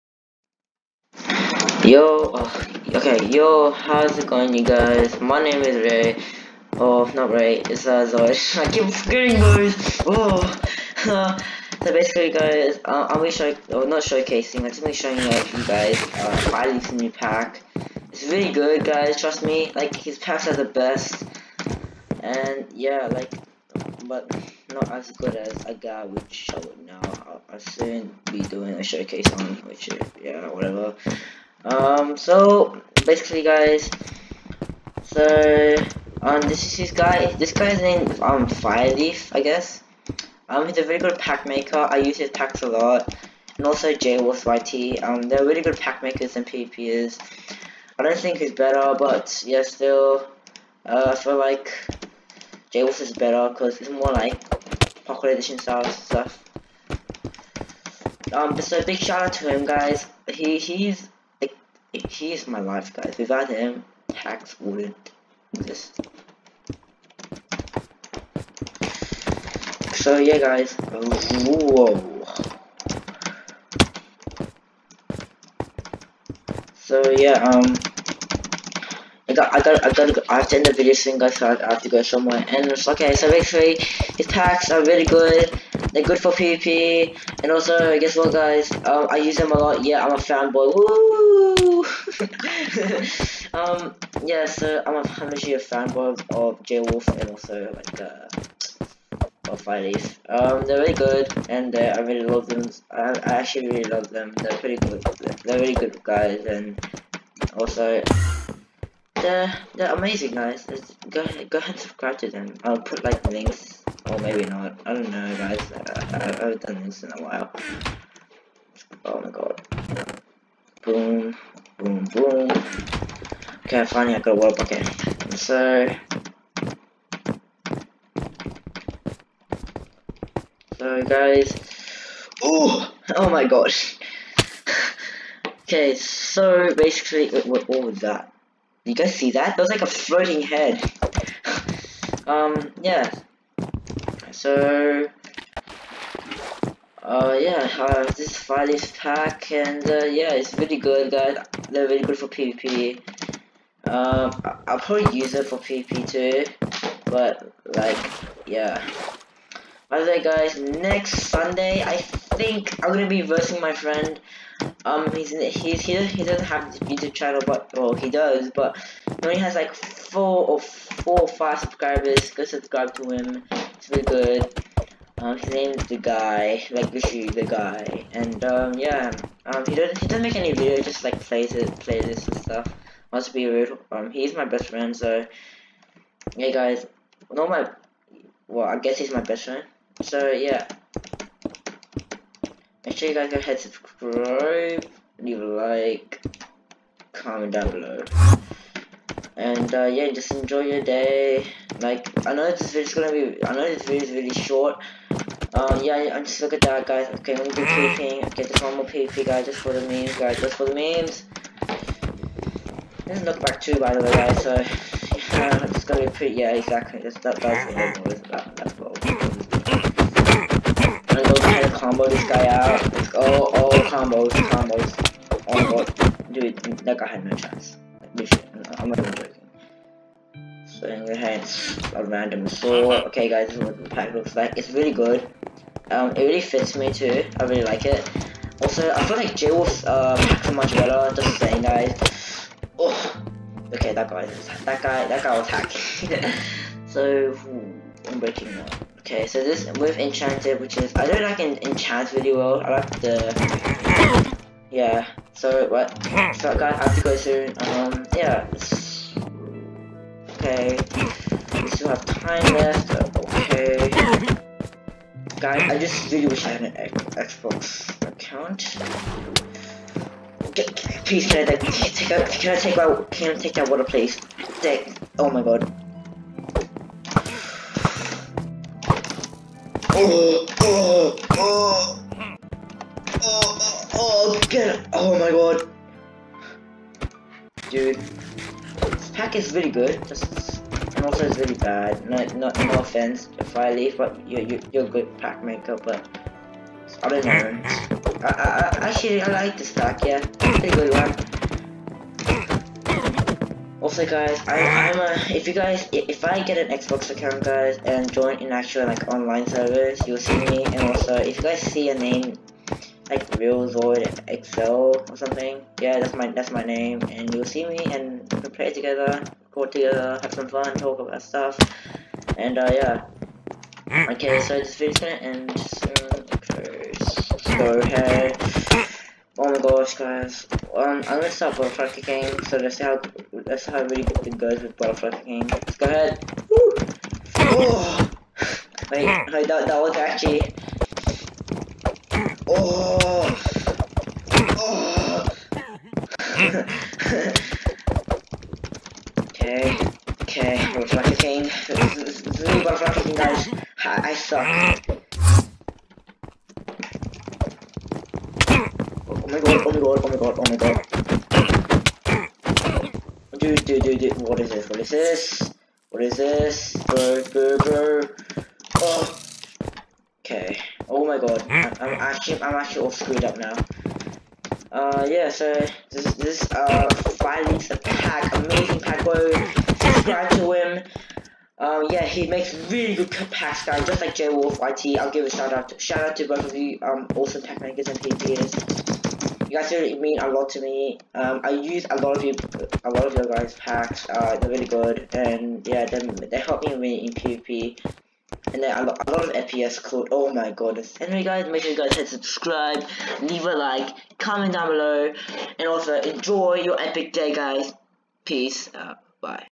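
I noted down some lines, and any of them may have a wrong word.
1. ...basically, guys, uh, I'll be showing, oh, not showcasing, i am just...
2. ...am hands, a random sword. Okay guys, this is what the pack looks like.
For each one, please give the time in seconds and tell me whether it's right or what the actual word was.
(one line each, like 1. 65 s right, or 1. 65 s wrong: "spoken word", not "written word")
1. 11 s right
2. 231 s right.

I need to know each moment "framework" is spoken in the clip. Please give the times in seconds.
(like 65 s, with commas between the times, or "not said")
not said.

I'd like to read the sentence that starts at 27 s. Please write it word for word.
I'll, I'll soon be doing a showcase on, which is, yeah, whatever.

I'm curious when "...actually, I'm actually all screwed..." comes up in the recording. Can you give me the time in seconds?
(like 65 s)
371 s.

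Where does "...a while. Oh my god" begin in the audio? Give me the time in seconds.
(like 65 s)
117 s.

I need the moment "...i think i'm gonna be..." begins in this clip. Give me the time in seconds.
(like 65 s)
161 s.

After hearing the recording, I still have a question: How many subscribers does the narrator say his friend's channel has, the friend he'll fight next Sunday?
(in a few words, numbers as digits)
4 or 5.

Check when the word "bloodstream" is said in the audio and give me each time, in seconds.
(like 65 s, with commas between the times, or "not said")
not said.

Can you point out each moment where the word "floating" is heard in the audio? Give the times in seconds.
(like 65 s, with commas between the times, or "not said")
139 s.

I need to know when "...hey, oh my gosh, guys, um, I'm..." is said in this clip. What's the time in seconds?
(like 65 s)
327 s.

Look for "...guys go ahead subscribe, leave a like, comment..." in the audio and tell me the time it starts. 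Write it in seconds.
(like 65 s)
193 s.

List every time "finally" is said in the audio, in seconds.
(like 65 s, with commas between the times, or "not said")
123 s, 377 s.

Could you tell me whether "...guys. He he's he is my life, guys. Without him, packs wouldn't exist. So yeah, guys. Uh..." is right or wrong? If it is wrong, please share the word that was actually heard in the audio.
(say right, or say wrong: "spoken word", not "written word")
wrong: "hacks", not "packs".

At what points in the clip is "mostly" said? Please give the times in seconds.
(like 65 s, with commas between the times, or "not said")
not said.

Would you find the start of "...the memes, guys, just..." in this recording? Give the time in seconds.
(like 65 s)
209 s.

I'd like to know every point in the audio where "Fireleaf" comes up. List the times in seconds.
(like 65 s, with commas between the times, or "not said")
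38 s, 99 s.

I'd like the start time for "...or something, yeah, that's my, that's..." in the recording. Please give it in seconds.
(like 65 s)
315 s.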